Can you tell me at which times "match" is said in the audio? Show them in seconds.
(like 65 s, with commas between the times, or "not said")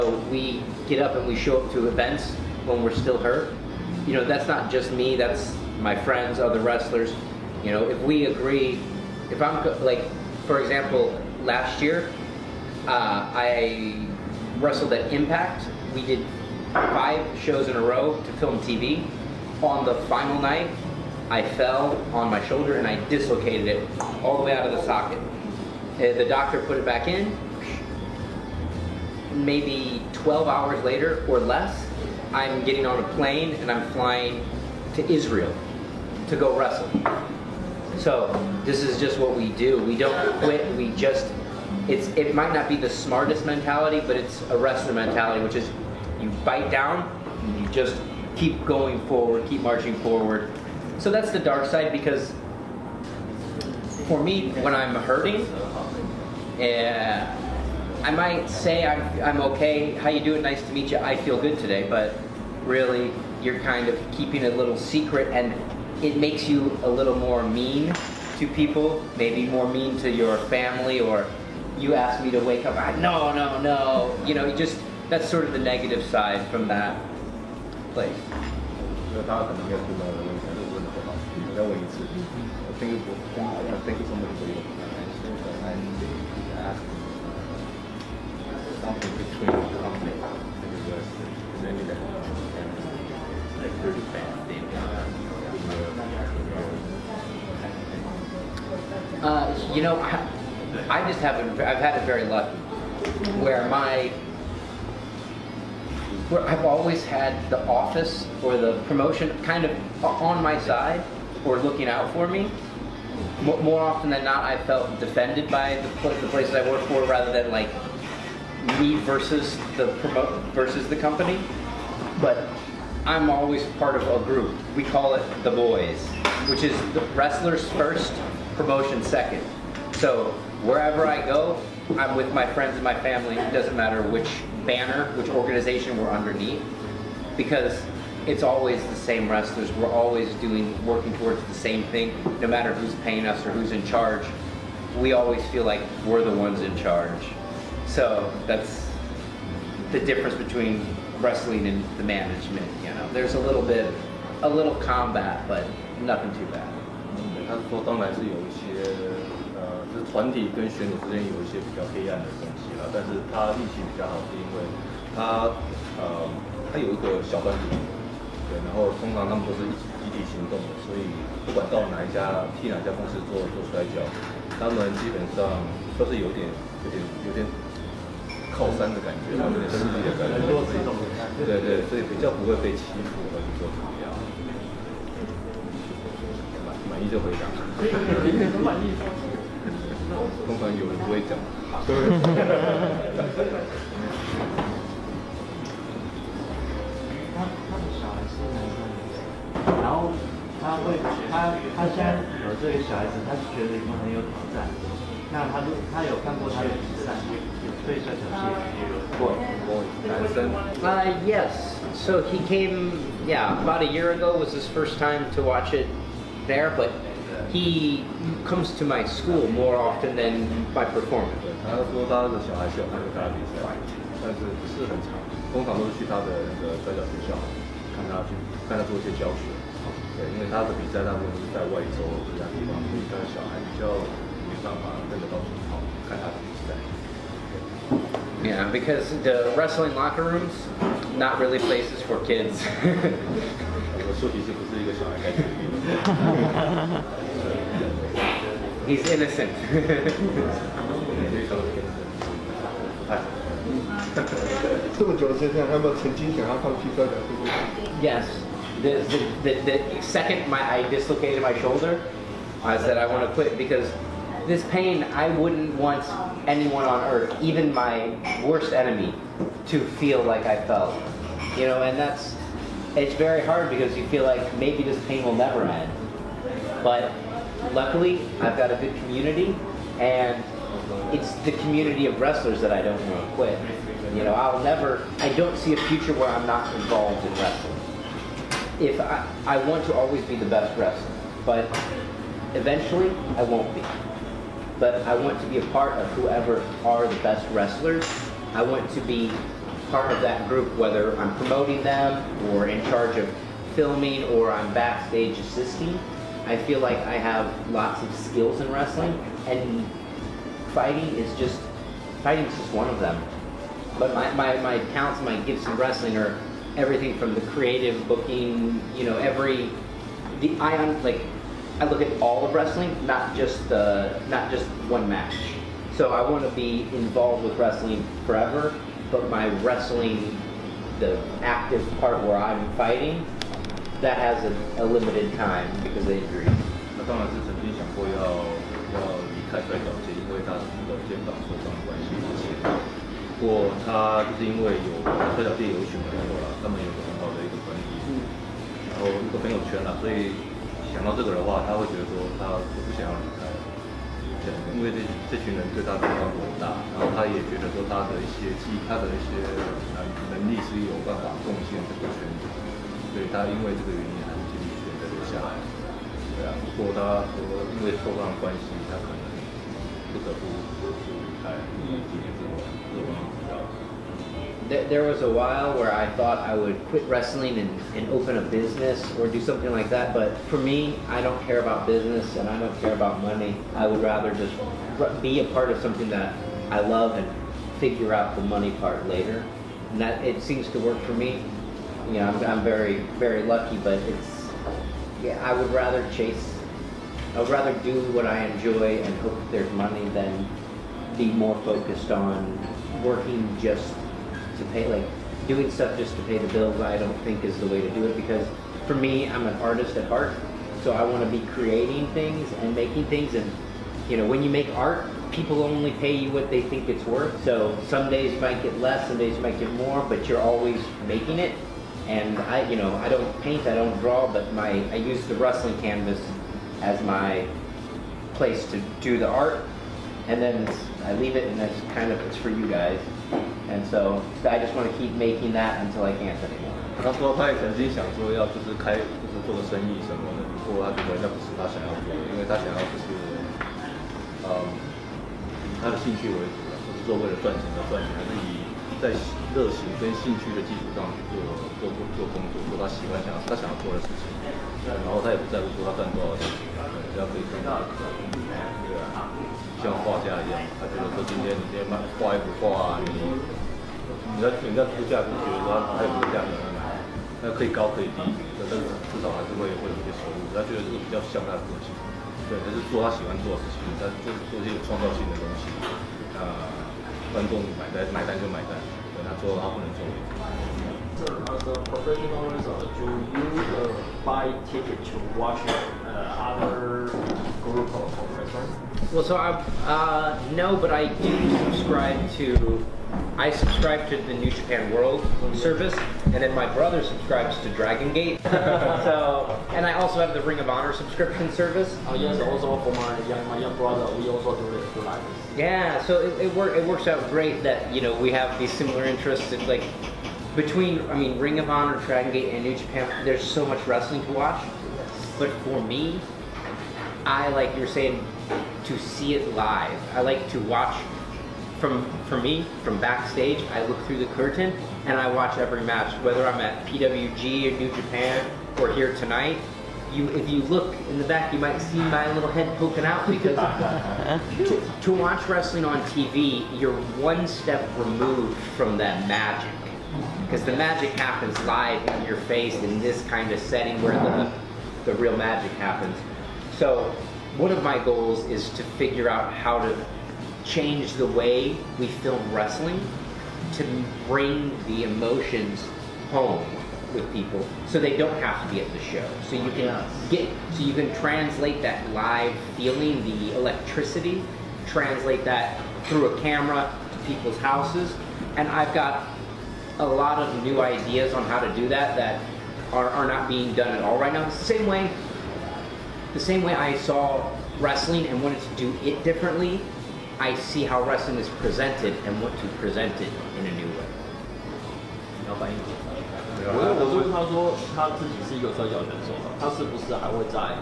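325 s, 525 s.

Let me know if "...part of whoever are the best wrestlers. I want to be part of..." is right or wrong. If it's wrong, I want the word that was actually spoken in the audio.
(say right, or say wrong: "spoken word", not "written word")
right.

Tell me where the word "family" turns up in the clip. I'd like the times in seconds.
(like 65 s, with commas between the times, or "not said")
70 s, 132 s.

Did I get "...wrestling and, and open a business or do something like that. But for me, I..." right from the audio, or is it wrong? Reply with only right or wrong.
right.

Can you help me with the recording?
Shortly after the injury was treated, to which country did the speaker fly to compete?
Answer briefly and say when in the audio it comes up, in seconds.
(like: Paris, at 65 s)
Israel, at 35 s.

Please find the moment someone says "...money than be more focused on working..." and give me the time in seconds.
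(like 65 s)
399 s.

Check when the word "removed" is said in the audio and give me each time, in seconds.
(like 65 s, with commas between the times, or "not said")
537 s.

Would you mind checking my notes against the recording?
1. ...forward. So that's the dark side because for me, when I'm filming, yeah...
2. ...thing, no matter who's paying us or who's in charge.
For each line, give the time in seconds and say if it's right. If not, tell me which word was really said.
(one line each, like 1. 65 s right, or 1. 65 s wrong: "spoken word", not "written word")
1. 49 s wrong: "hurting", not "filming"
2. 141 s right.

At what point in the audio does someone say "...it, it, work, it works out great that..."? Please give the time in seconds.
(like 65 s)
506 s.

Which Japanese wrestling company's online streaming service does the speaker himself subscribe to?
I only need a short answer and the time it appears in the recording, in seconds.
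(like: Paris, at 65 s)
New Japan World, at 494 s.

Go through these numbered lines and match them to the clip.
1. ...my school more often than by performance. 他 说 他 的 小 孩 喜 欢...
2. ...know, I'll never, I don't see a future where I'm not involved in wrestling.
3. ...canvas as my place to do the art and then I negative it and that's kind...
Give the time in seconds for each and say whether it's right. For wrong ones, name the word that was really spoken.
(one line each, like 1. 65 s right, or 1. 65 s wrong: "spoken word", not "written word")
1. 218 s right
2. 284 s right
3. 425 s wrong: "leave", not "negative".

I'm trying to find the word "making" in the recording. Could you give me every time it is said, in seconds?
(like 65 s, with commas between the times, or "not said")
412 s, 421 s, 435 s.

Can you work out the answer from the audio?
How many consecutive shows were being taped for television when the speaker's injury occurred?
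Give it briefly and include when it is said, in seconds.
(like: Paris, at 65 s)
5, at 16 s.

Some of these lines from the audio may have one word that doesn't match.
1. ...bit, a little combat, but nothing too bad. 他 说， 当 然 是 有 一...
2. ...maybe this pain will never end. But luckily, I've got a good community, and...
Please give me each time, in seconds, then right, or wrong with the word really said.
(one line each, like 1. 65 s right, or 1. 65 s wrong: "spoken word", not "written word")
1. 153 s right
2. 274 s right.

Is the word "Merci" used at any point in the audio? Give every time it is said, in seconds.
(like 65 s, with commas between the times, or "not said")
not said.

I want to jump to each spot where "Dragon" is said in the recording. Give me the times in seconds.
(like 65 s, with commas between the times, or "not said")
497 s, 512 s.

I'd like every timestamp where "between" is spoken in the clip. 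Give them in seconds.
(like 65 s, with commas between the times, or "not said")
88 s, 150 s, 510 s.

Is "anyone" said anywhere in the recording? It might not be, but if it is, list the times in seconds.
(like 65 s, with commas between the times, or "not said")
266 s.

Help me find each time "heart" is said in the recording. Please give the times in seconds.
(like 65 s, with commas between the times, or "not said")
410 s.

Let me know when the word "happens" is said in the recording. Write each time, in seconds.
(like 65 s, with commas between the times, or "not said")
541 s, 545 s.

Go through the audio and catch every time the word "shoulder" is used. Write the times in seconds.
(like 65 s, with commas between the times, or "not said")
22 s, 261 s.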